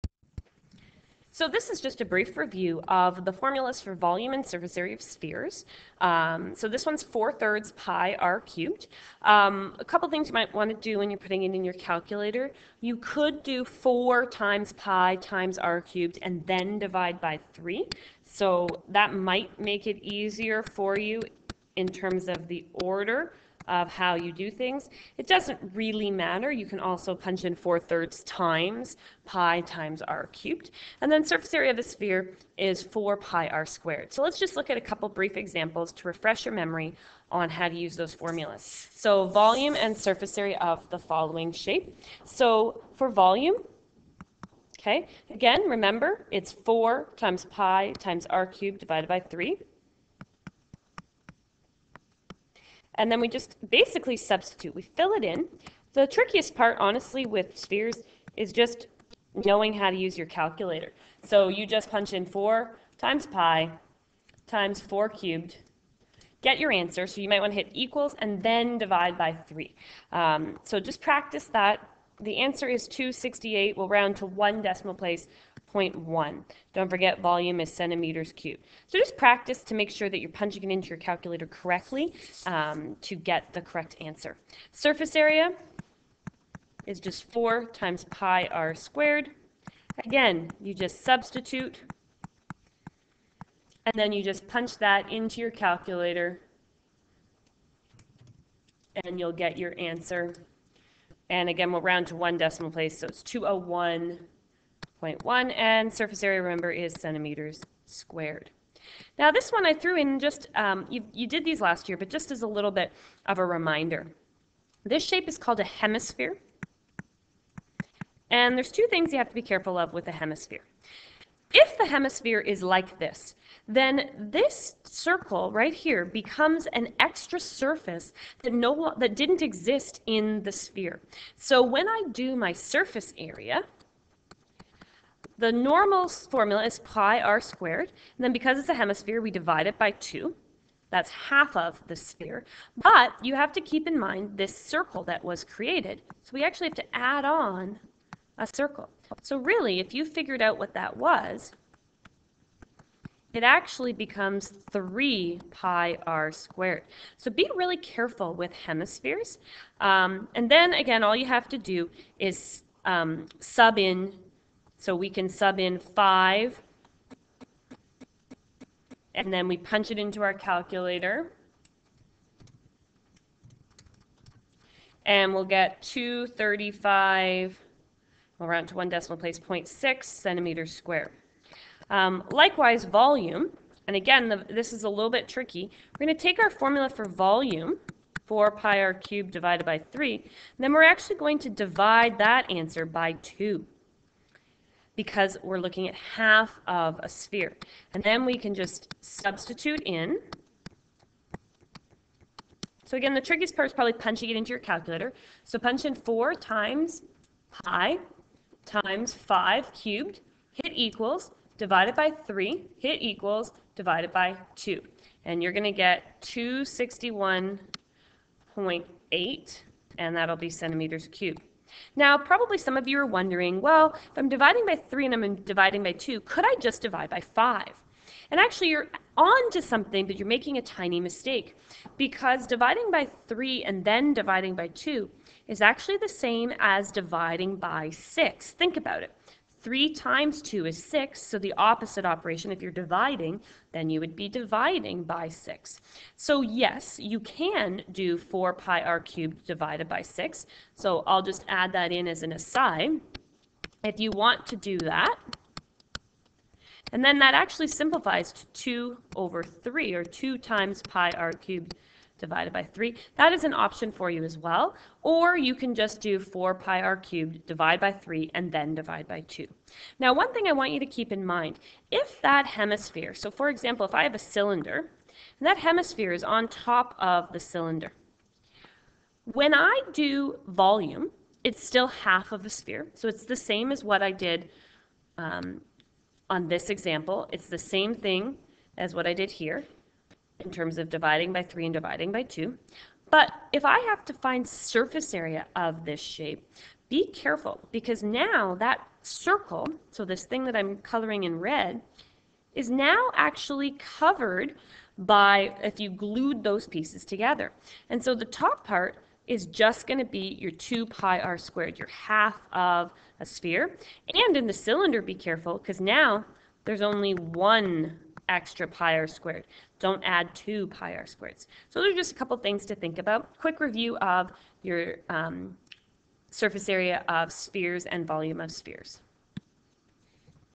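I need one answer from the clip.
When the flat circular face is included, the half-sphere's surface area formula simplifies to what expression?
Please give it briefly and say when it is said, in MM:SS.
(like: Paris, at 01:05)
3 pi r squared, at 02:34.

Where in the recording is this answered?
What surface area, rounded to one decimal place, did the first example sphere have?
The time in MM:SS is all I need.
01:43.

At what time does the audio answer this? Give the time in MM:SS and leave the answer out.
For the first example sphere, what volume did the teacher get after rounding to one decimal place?
01:12.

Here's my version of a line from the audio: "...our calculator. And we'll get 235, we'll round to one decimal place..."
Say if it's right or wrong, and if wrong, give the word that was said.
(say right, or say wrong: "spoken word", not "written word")
right.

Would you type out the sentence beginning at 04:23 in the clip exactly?
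That is an option for you as well.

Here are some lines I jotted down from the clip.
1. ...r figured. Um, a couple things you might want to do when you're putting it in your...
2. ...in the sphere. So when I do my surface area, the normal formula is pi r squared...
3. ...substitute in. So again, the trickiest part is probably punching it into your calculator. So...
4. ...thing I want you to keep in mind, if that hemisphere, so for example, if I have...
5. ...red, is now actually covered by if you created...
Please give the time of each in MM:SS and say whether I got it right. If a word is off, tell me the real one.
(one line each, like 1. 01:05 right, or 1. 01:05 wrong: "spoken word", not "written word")
1. 00:08 wrong: "cubed", not "figured"
2. 02:10 right
3. 03:19 right
4. 04:30 right
5. 05:01 wrong: "glued", not "created".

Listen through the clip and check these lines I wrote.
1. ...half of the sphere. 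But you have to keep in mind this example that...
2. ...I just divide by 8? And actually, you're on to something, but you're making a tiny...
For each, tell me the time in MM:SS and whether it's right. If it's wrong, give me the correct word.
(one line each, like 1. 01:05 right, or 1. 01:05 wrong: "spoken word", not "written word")
1. 02:21 wrong: "circle", not "example"
2. 03:46 wrong: "5", not "8".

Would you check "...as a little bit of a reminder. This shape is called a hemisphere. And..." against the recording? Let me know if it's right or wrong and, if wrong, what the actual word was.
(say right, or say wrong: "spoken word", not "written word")
right.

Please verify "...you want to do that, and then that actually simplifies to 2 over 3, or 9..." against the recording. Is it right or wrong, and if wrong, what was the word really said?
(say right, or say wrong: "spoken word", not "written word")
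wrong: "2", not "9".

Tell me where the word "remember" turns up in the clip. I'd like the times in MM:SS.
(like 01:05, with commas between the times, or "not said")
00:45, 01:46.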